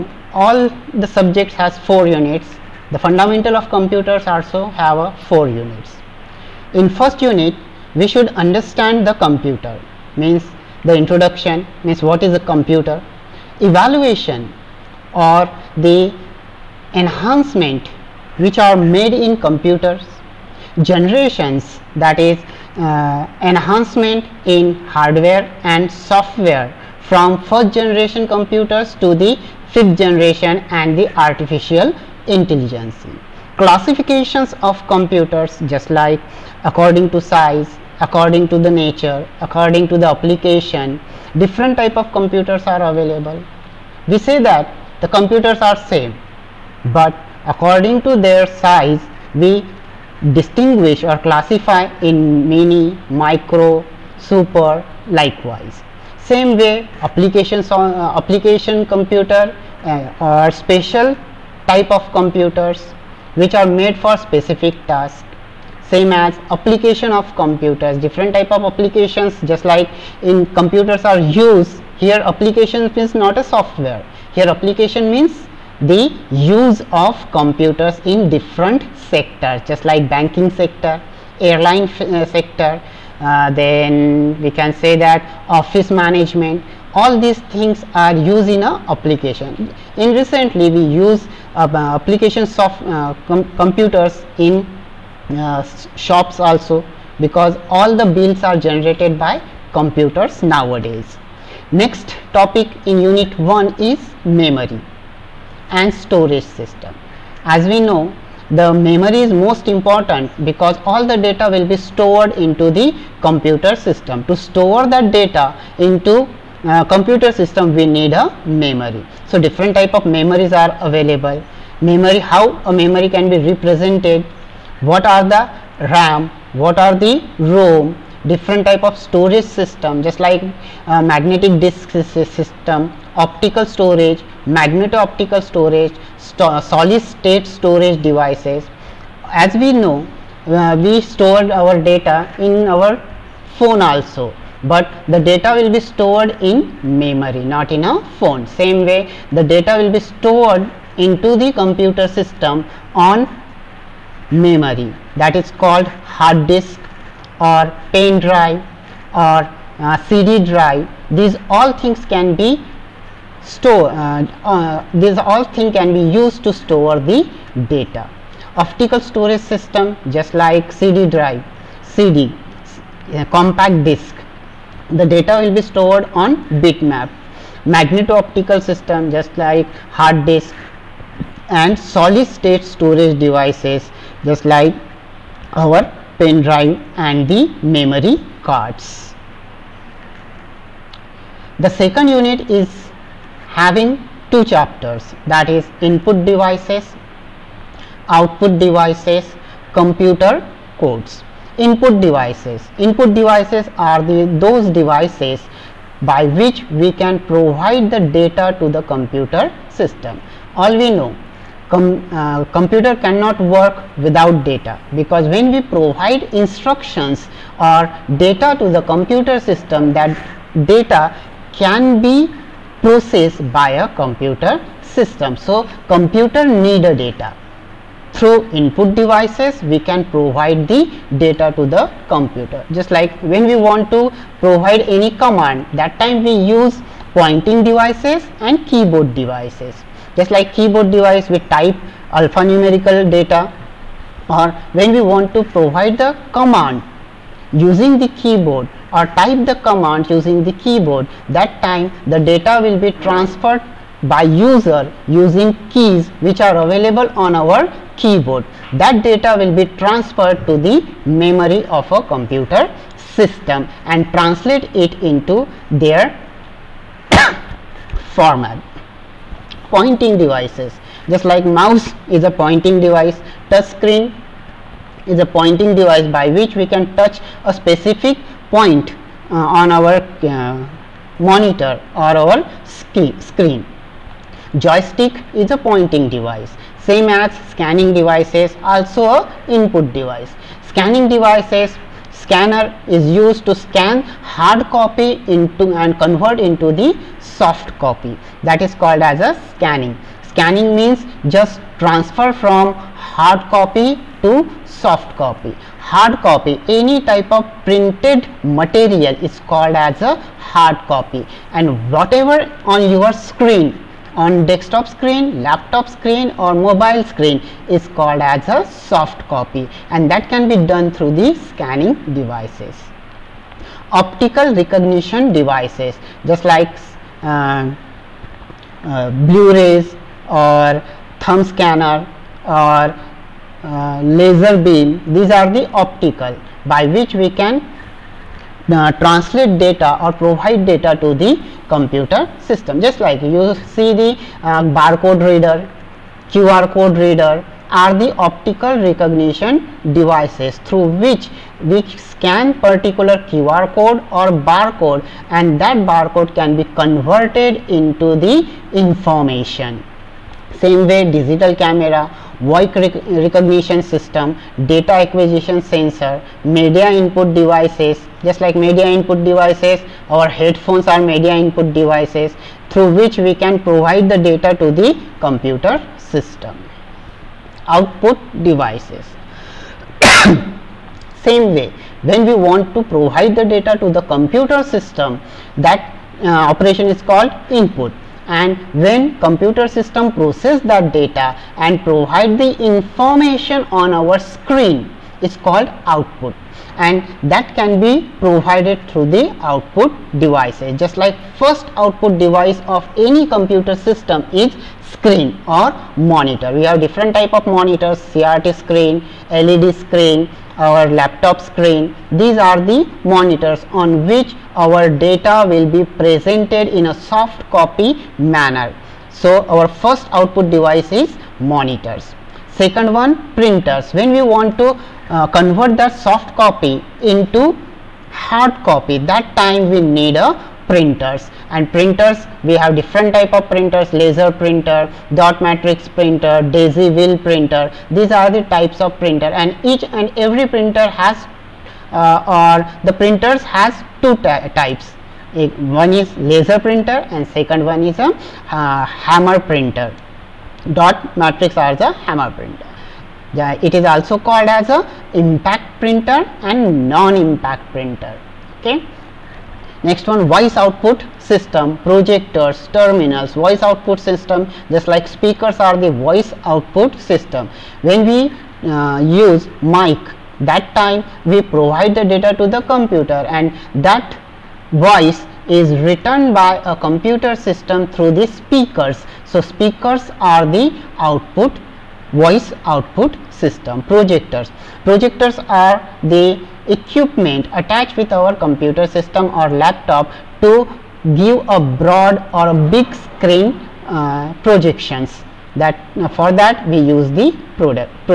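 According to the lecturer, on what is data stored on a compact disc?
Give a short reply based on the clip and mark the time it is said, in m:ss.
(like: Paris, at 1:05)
bitmap, at 2:56.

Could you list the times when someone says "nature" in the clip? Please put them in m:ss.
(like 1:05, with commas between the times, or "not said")
0:38.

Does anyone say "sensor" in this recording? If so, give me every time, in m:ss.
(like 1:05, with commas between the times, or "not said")
6:05.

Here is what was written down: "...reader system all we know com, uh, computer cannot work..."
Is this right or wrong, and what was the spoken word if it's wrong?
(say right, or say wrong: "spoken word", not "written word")
wrong: "computer", not "reader".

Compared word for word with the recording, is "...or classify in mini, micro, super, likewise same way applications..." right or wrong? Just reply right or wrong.
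right.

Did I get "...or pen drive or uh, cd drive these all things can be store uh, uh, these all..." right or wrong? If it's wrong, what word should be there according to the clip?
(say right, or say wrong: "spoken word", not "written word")
right.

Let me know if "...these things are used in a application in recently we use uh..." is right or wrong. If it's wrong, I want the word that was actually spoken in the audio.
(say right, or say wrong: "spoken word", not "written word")
right.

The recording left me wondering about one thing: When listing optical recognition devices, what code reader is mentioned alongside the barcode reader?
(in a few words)
QR code reader.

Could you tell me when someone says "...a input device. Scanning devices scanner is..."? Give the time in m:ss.
4:49.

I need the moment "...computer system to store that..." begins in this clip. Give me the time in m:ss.
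1:53.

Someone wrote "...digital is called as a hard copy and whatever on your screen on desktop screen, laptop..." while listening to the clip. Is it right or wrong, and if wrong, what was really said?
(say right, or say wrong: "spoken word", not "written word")
wrong: "material", not "digital".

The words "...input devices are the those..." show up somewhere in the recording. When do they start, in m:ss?
3:22.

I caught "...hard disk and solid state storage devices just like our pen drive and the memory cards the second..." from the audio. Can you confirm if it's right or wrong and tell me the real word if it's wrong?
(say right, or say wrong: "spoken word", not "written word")
right.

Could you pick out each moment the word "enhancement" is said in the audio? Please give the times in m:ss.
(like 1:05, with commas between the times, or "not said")
0:16, 0:23.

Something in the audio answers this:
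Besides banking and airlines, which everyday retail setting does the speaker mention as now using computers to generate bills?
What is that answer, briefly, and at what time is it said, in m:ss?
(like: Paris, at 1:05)
shops, at 1:35.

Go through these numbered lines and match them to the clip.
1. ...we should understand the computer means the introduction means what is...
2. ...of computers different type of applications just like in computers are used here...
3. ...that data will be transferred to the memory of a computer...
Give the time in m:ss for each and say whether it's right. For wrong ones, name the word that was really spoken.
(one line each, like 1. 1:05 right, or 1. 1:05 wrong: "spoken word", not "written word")
1. 0:07 right
2. 1:07 right
3. 4:18 right.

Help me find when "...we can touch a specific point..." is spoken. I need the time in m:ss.
4:36.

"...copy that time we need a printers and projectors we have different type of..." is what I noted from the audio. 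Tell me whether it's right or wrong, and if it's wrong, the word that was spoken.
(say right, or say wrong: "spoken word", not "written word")
wrong: "printers", not "projectors".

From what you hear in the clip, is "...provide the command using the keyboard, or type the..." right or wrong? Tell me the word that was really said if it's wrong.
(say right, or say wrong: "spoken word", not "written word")
right.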